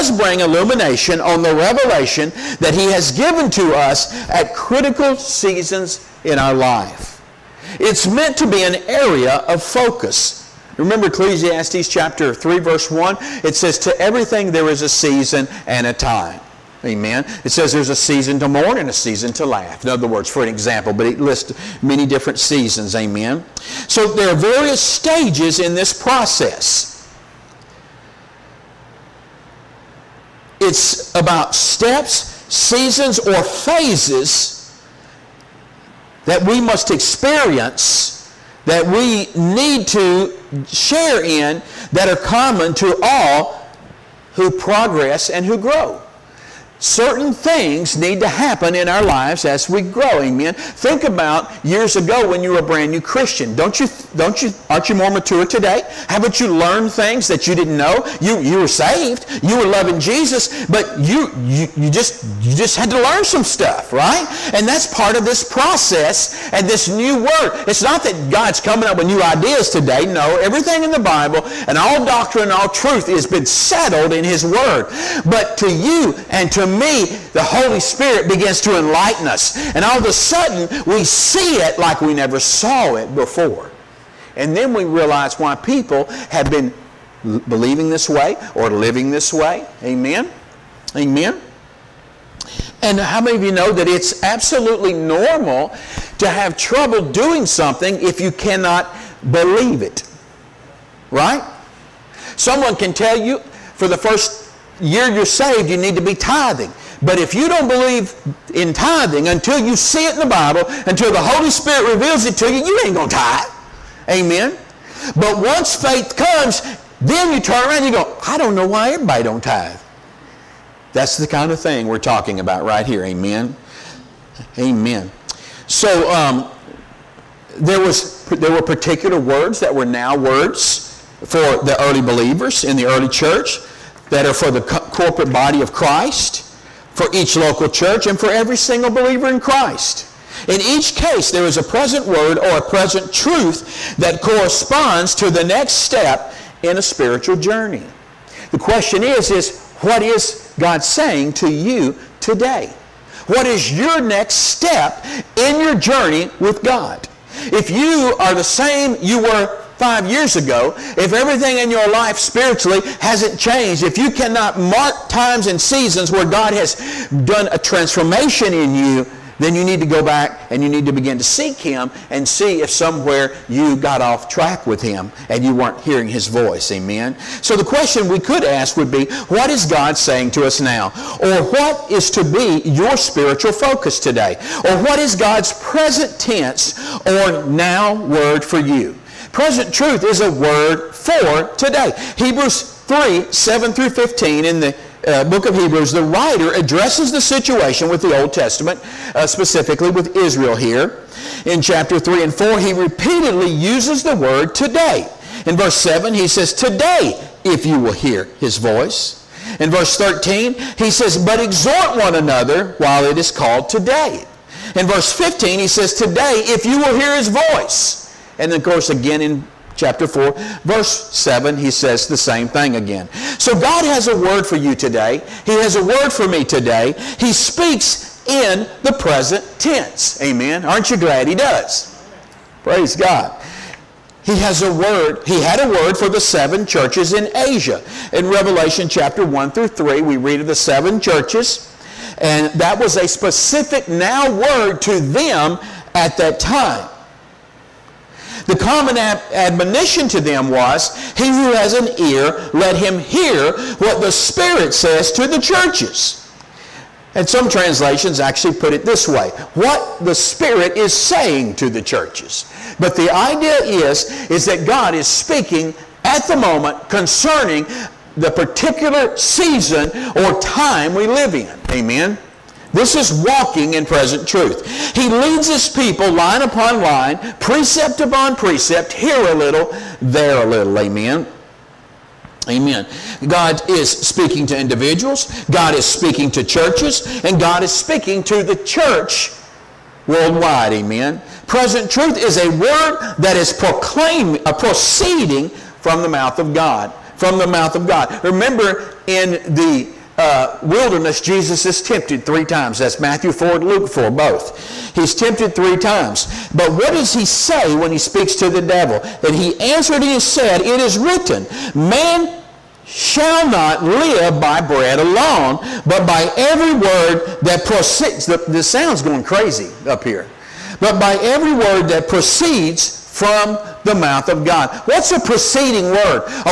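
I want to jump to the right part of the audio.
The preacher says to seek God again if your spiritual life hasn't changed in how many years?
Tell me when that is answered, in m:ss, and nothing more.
2:39.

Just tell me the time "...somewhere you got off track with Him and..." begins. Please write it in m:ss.
2:52.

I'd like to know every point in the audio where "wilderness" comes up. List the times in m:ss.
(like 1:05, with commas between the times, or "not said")
5:00.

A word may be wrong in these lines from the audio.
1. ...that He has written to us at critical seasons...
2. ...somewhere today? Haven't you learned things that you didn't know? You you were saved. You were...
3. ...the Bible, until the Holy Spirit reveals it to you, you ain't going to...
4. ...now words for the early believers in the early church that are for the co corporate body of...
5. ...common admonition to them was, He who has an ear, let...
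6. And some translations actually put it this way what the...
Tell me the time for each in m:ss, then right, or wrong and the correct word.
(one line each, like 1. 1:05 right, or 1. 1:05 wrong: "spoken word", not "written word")
1. 0:02 wrong: "given", not "written"
2. 0:55 wrong: "mature", not "somewhere"
3. 1:50 right
4. 2:09 right
5. 4:08 right
6. 4:17 right.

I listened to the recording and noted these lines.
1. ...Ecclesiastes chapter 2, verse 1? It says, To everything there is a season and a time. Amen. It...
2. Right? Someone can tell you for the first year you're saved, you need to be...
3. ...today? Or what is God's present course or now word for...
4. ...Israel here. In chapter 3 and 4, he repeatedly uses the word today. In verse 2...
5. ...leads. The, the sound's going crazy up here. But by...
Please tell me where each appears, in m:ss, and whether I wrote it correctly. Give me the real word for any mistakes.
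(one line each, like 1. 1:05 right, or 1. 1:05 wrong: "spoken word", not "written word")
1. 0:11 wrong: "3", not "2"
2. 1:41 right
3. 3:03 wrong: "tense", not "course"
4. 3:20 wrong: "7", not "2"
5. 5:17 wrong: "proceeds", not "leads".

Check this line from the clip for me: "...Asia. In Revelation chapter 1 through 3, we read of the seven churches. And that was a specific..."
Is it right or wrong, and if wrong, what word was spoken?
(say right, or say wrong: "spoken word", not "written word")
right.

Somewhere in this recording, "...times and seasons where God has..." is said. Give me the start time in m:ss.
2:45.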